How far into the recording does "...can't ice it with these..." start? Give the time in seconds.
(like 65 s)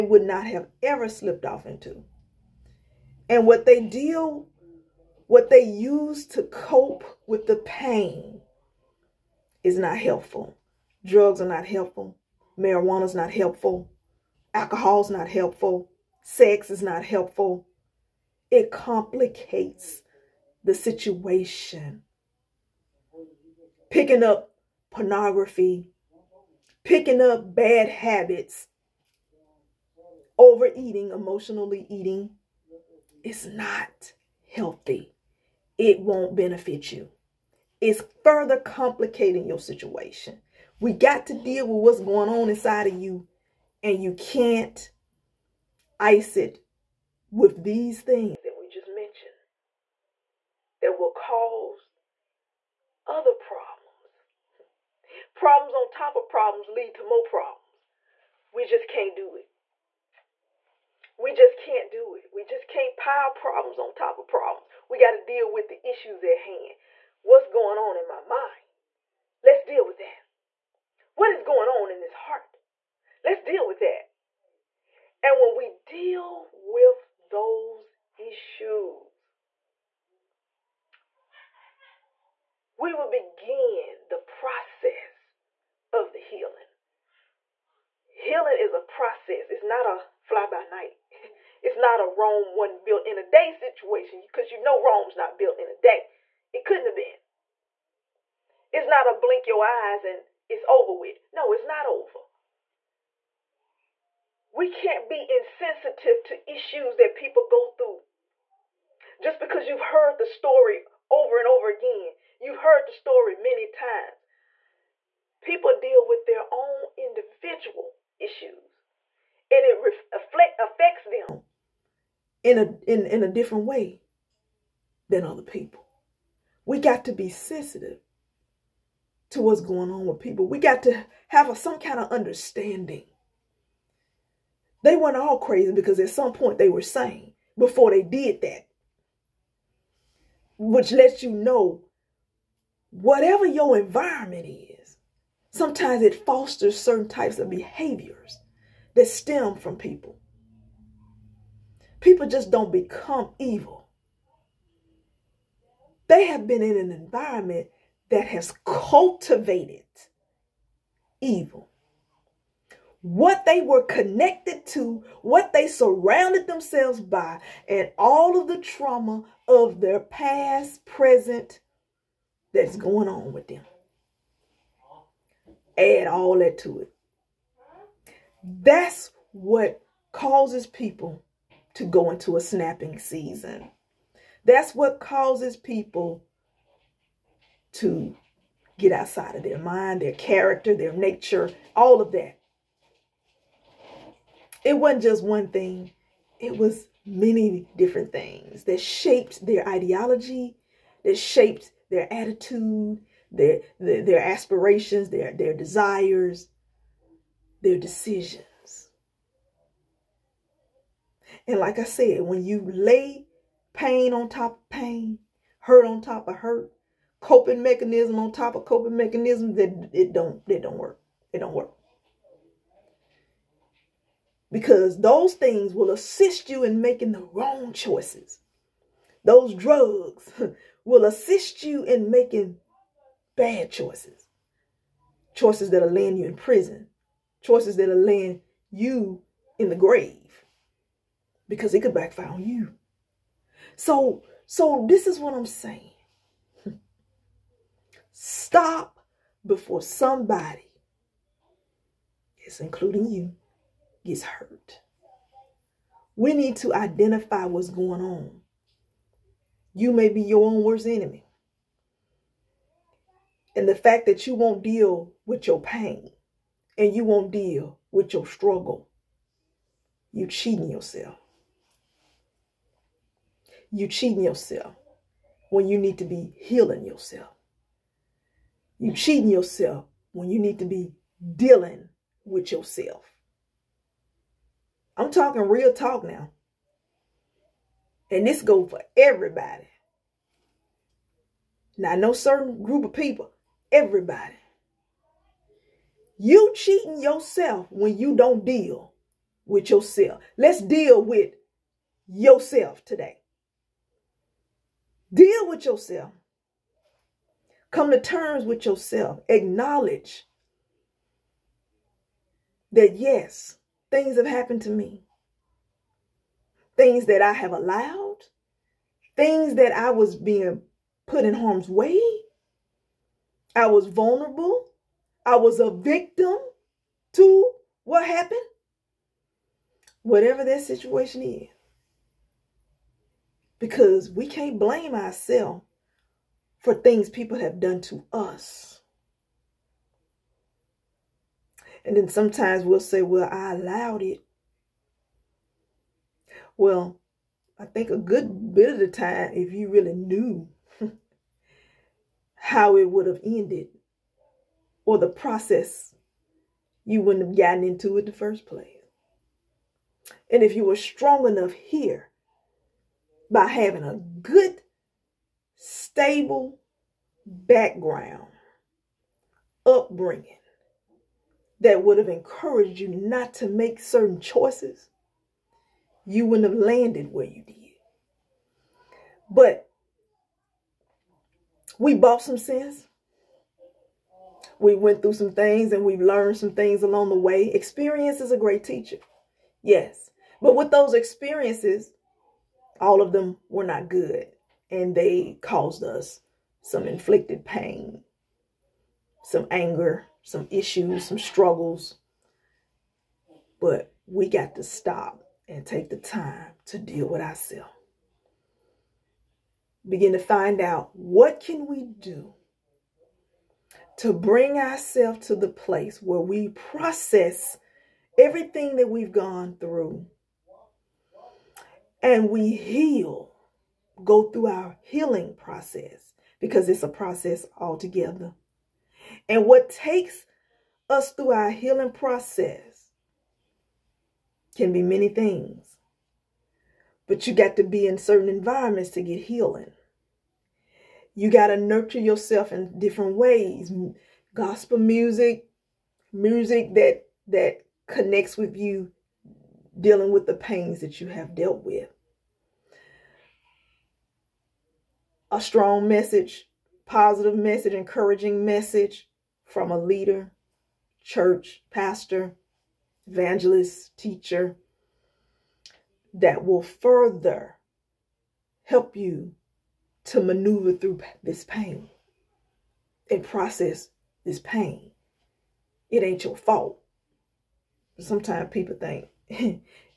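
44 s.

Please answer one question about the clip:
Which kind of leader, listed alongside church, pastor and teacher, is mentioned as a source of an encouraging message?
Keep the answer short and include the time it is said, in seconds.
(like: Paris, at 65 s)
evangelist, at 463 s.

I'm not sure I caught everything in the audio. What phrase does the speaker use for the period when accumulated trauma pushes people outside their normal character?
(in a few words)
snapping season.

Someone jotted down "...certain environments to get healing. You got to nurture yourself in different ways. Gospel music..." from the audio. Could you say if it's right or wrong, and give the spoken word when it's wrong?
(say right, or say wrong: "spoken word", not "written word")
right.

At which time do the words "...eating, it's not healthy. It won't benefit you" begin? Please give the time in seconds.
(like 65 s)
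31 s.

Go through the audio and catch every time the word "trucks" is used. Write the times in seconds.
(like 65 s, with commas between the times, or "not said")
not said.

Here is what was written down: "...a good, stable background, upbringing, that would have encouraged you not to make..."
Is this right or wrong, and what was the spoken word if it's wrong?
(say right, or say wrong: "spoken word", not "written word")
right.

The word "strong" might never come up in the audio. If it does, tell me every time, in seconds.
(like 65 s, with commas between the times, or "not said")
360 s, 455 s.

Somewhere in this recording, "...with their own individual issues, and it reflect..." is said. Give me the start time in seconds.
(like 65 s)
116 s.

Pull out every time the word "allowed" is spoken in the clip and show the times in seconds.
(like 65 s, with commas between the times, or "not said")
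317 s, 343 s.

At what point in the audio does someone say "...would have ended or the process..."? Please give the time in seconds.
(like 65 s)
352 s.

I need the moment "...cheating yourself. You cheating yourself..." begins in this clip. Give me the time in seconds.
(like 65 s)
270 s.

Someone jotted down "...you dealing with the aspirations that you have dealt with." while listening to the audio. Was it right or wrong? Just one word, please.
wrong.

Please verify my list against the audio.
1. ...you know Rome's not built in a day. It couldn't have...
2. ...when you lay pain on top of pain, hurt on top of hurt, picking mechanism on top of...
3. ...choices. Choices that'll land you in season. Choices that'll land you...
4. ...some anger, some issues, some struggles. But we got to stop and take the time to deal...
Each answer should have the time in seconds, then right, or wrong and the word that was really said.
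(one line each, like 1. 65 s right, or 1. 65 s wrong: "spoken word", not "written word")
1. 94 s right
2. 212 s wrong: "coping", not "picking"
3. 233 s wrong: "prison", not "season"
4. 399 s right.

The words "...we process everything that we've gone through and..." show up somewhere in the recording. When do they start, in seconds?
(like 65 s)
416 s.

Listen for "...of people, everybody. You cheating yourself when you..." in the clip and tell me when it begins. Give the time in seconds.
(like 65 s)
292 s.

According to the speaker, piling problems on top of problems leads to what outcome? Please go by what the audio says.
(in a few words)
more problems.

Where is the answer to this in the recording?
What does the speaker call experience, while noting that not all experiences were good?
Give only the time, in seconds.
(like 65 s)
388 s.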